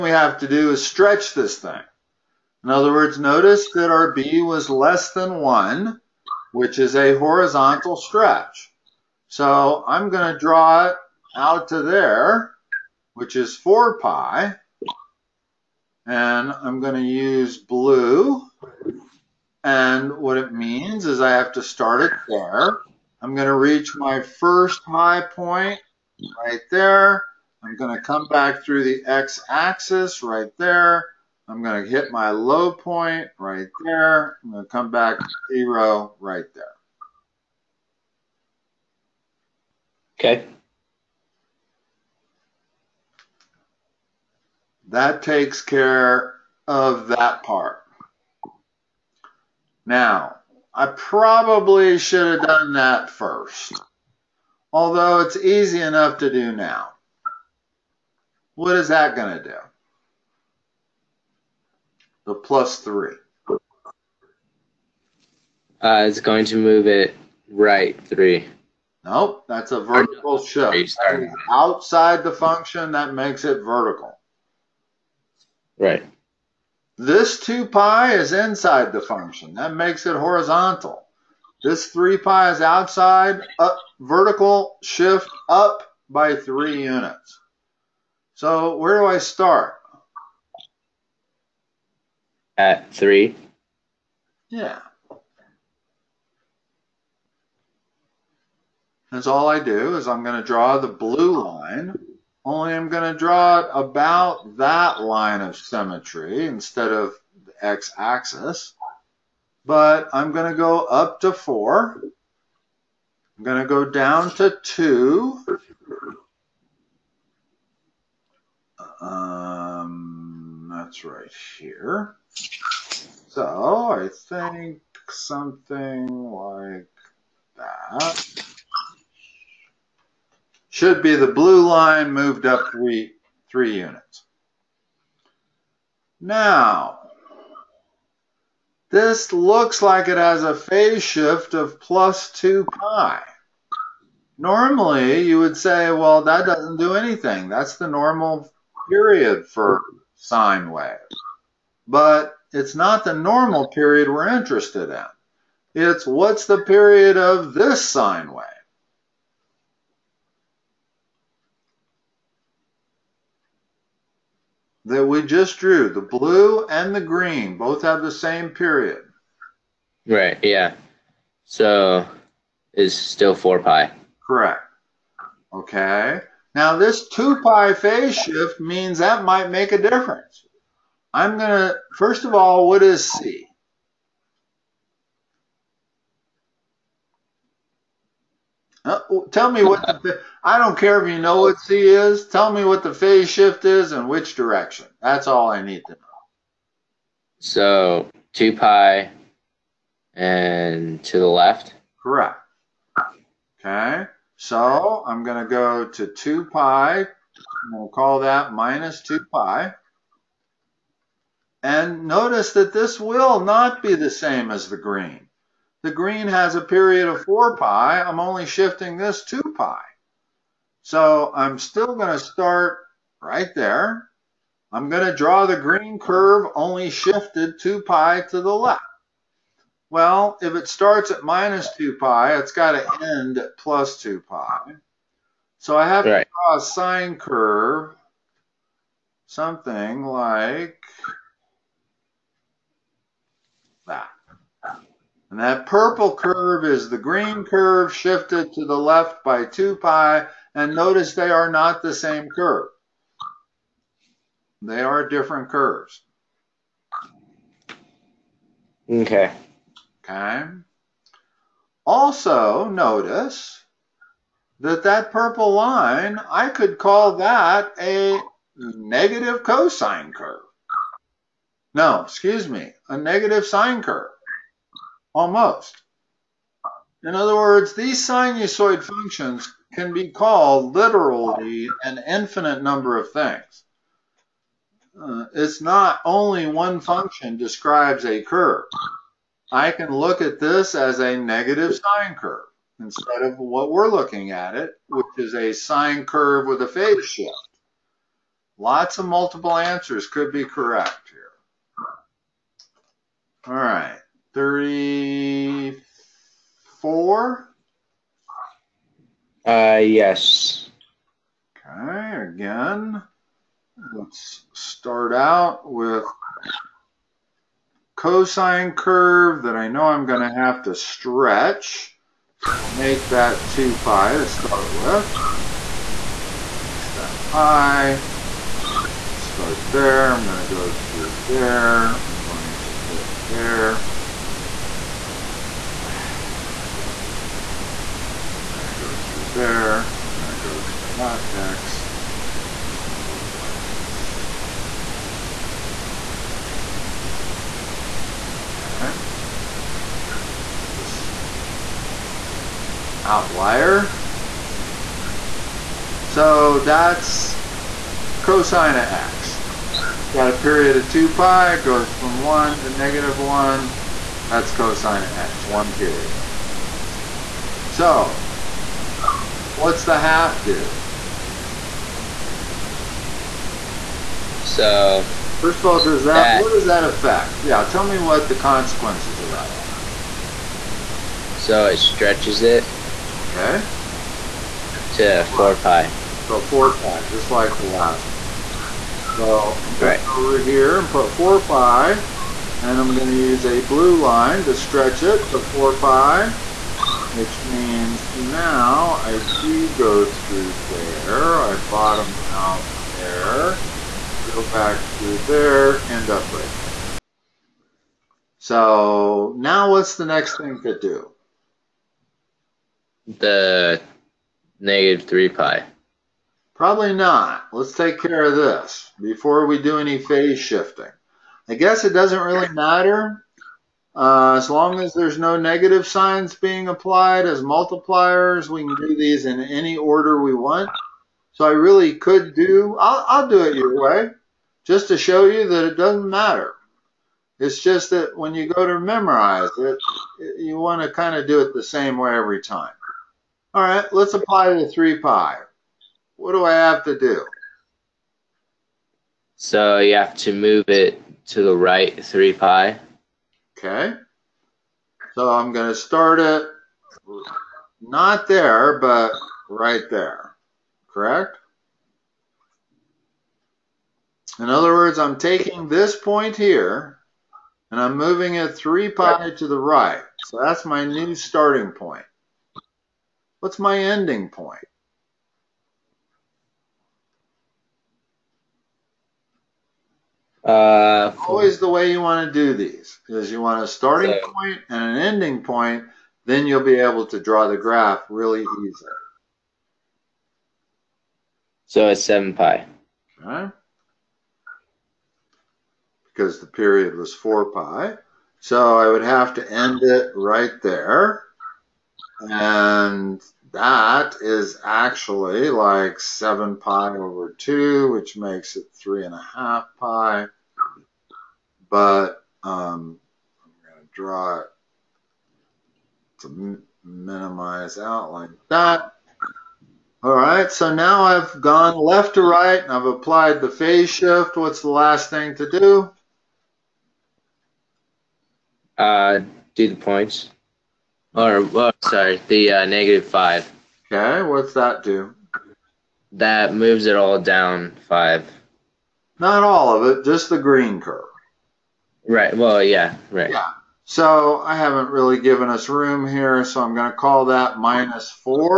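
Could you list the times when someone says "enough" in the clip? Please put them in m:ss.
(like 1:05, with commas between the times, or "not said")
0:55.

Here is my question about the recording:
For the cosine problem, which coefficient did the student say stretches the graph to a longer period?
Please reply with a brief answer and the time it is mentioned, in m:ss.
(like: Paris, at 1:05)
the half, at 6:09.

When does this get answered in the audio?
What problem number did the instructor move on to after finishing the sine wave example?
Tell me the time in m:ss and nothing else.
5:03.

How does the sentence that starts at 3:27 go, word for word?
We'll call that minus 2 pi.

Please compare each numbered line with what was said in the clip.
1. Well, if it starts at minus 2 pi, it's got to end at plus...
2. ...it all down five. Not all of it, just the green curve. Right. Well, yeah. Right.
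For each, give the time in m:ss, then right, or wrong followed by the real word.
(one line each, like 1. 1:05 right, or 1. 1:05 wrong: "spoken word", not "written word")
1. 3:49 right
2. 8:56 right.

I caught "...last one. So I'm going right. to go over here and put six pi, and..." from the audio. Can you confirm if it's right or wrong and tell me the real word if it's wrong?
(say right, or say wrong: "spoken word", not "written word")
wrong: "four", not "six".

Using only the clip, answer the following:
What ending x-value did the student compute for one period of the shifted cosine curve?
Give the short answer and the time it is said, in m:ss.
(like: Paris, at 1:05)
7 pi, at 8:11.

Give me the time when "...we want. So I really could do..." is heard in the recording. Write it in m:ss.
7:10.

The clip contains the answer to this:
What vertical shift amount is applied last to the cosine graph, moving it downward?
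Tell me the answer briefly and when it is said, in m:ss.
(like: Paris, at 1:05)
5, at 8:52.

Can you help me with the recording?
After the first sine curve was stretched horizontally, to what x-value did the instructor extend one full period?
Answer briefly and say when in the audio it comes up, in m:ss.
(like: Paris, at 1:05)
4 pi, at 0:13.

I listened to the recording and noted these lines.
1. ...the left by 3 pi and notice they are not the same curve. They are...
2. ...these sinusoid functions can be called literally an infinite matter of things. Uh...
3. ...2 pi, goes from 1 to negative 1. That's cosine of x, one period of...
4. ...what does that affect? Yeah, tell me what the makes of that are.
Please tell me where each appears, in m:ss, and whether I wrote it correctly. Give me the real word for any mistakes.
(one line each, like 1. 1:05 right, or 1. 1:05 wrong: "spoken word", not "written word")
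1. 4:08 wrong: "2", not "3"
2. 4:37 wrong: "number", not "matter"
3. 6:00 right
4. 6:16 wrong: "consequences", not "makes".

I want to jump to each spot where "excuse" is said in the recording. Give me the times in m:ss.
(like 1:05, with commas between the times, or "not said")
4:32.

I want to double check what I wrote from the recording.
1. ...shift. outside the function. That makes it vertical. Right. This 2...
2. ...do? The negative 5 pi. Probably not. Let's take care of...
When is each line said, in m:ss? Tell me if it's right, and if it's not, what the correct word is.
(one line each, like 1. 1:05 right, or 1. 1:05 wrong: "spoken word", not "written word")
1. 1:10 right
2. 6:50 wrong: "3", not "5".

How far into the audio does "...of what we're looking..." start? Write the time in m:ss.
4:53.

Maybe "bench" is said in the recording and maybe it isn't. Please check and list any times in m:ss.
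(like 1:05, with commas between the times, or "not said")
not said.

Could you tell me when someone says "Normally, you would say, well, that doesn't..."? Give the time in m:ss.
2:24.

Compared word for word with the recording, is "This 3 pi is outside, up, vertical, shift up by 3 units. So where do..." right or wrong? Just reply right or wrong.
right.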